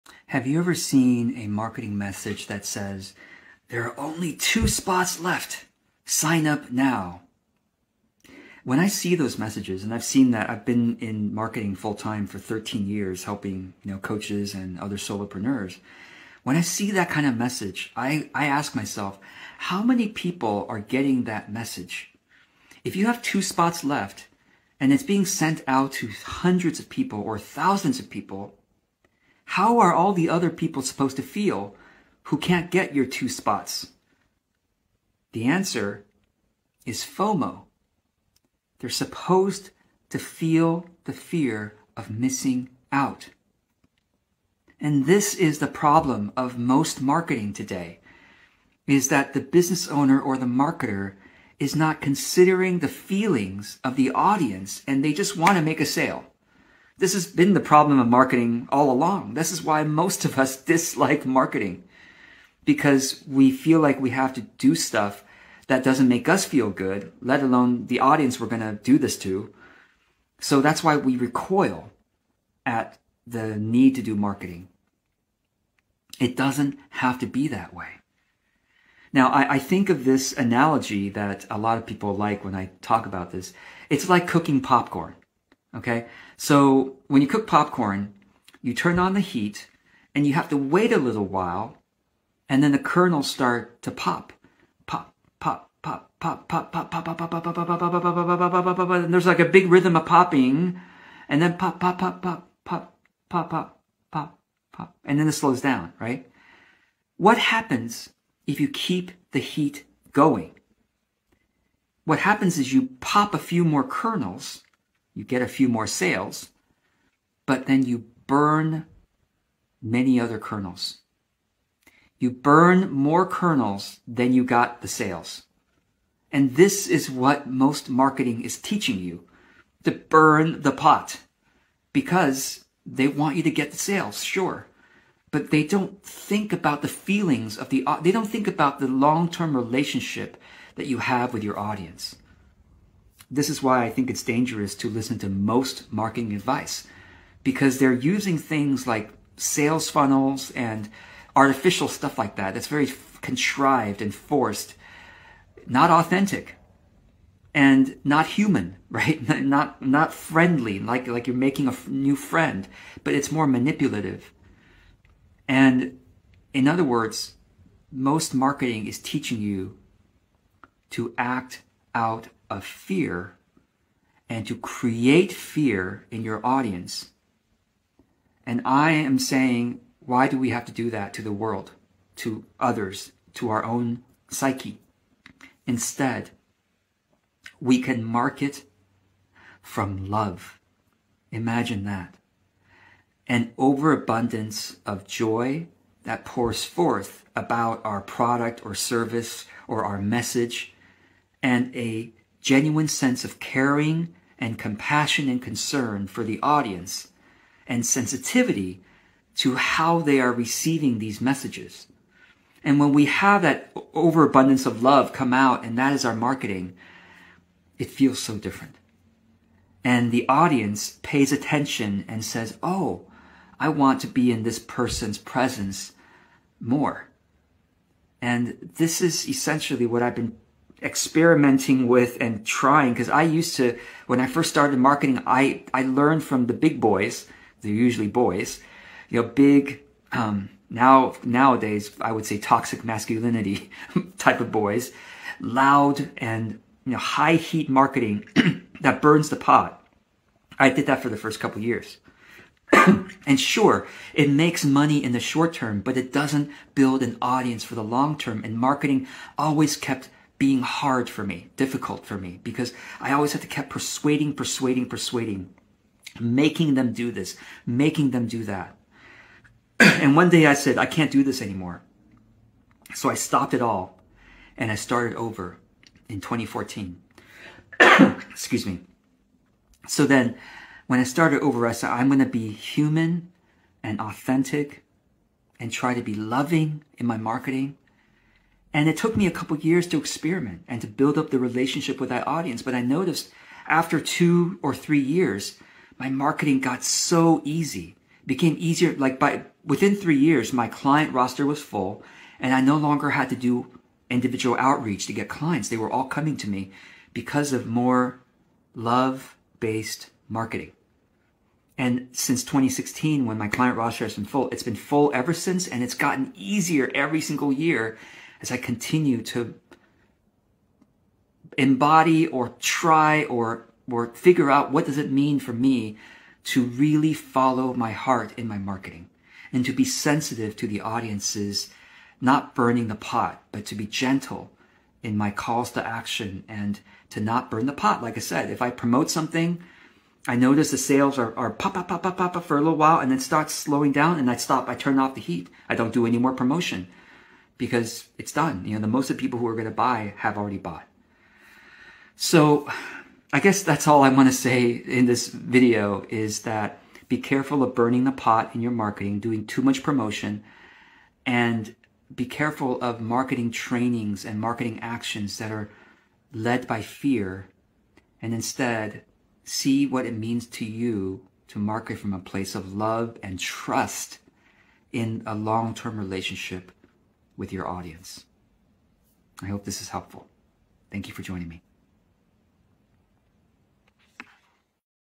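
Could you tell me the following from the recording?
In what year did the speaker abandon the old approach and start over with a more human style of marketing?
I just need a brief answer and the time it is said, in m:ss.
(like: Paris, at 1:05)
2014, at 4:36.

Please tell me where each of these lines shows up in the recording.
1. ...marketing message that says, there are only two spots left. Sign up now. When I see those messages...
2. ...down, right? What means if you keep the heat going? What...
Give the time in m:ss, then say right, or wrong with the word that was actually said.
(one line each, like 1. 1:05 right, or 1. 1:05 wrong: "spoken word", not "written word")
1. 0:01 right
2. 1:45 wrong: "happens", not "means".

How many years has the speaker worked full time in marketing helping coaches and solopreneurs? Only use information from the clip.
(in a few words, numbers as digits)
13.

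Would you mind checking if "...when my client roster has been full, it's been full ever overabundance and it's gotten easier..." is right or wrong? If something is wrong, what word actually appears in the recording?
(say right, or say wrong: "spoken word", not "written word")
wrong: "since", not "overabundance".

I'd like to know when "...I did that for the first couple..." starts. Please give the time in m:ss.
4:10.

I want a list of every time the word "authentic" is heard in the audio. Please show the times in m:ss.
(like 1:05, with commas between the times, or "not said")
2:35, 4:44.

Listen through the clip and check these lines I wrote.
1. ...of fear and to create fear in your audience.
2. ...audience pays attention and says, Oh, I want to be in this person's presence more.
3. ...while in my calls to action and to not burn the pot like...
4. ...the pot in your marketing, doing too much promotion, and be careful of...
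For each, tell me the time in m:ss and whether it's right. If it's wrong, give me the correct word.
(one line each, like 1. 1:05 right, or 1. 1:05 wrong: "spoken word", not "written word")
1. 2:52 right
2. 3:40 right
3. 5:33 wrong: "gentle", not "while"
4. 5:58 right.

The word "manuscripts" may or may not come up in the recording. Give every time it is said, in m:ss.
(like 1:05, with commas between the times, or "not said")
not said.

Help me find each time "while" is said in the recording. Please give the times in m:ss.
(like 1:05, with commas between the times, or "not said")
1:31, 5:42.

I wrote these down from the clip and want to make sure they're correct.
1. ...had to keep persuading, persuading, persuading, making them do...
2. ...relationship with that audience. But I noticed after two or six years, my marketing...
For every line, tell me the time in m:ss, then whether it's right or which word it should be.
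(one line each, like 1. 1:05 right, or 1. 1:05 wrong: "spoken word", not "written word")
1. 4:23 right
2. 4:51 wrong: "three", not "six".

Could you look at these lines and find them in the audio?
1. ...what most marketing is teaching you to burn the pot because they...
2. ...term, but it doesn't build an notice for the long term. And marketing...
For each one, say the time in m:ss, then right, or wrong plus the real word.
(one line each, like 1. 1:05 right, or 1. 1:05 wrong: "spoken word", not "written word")
1. 2:07 right
2. 4:15 wrong: "audience", not "notice".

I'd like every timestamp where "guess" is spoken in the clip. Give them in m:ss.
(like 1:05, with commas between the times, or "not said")
5:53.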